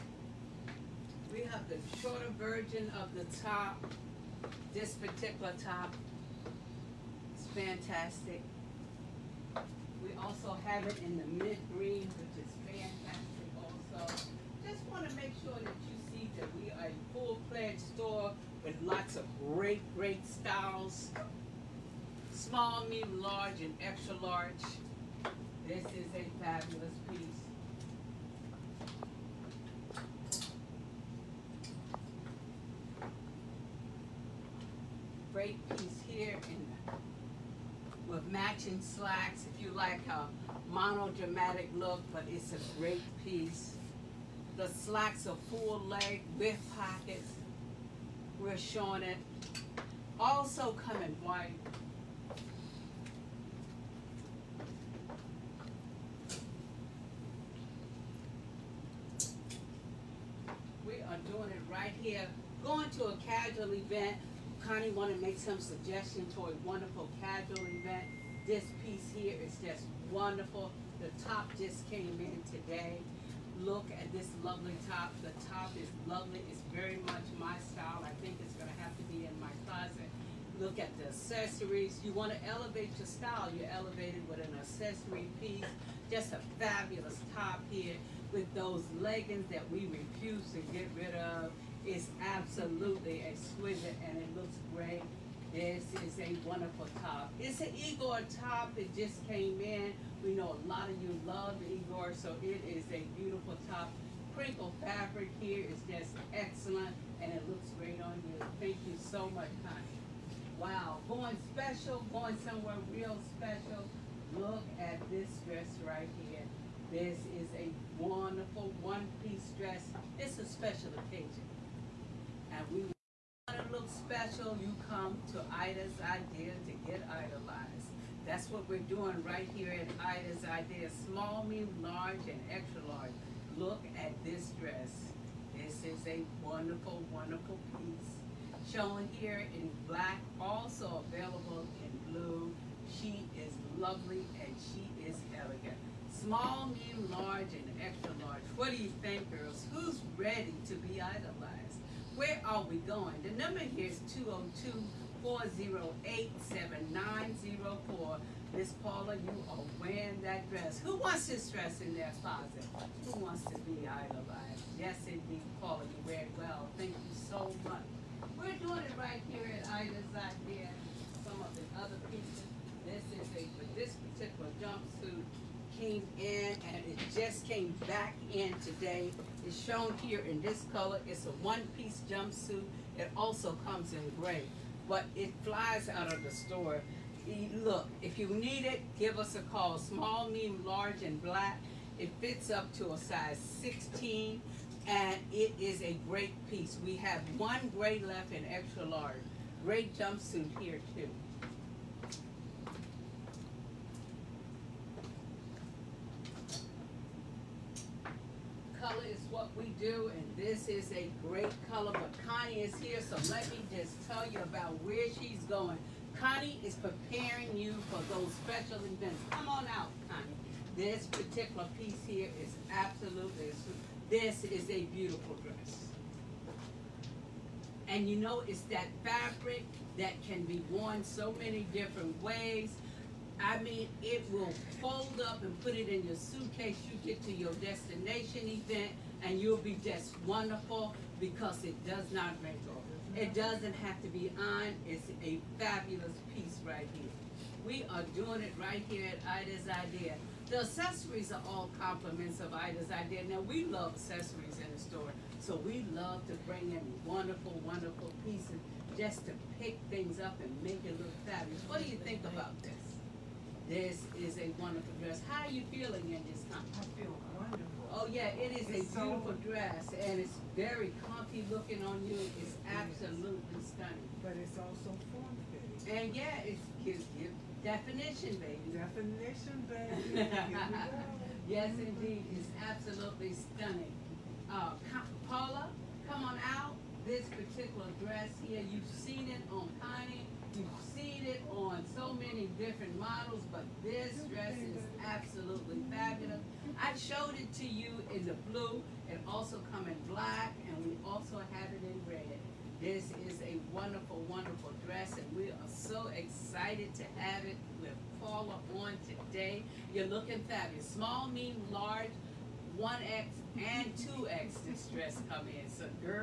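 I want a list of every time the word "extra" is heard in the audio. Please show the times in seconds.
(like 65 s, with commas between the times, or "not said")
23 s, 132 s, 147 s, 198 s.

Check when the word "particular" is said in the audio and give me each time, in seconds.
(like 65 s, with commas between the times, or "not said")
4 s, 174 s, 221 s, 287 s.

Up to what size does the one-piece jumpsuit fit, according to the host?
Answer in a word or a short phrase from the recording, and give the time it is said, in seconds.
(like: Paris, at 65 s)
16, at 191 s.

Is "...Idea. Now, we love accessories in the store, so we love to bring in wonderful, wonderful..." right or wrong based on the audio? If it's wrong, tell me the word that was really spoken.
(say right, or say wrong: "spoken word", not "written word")
right.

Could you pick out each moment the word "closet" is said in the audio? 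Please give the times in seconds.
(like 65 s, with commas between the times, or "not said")
79 s, 162 s.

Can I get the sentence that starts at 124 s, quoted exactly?
You come to Ida's Idea to get idolized.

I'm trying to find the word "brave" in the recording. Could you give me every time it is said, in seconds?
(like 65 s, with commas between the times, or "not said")
not said.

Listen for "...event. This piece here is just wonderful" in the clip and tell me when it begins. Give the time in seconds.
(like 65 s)
67 s.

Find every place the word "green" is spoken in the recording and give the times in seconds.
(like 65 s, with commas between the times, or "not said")
11 s.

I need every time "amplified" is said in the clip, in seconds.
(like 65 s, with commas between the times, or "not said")
not said.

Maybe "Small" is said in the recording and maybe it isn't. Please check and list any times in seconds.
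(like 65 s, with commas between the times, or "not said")
22 s, 131 s, 146 s, 189 s, 310 s.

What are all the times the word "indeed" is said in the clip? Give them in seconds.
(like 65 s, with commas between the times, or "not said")
165 s, 281 s.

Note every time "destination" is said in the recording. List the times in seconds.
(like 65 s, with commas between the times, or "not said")
237 s.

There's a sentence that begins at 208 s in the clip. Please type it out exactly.
color is what we do, and this is a great color.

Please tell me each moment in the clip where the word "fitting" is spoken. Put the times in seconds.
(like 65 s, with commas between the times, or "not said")
275 s.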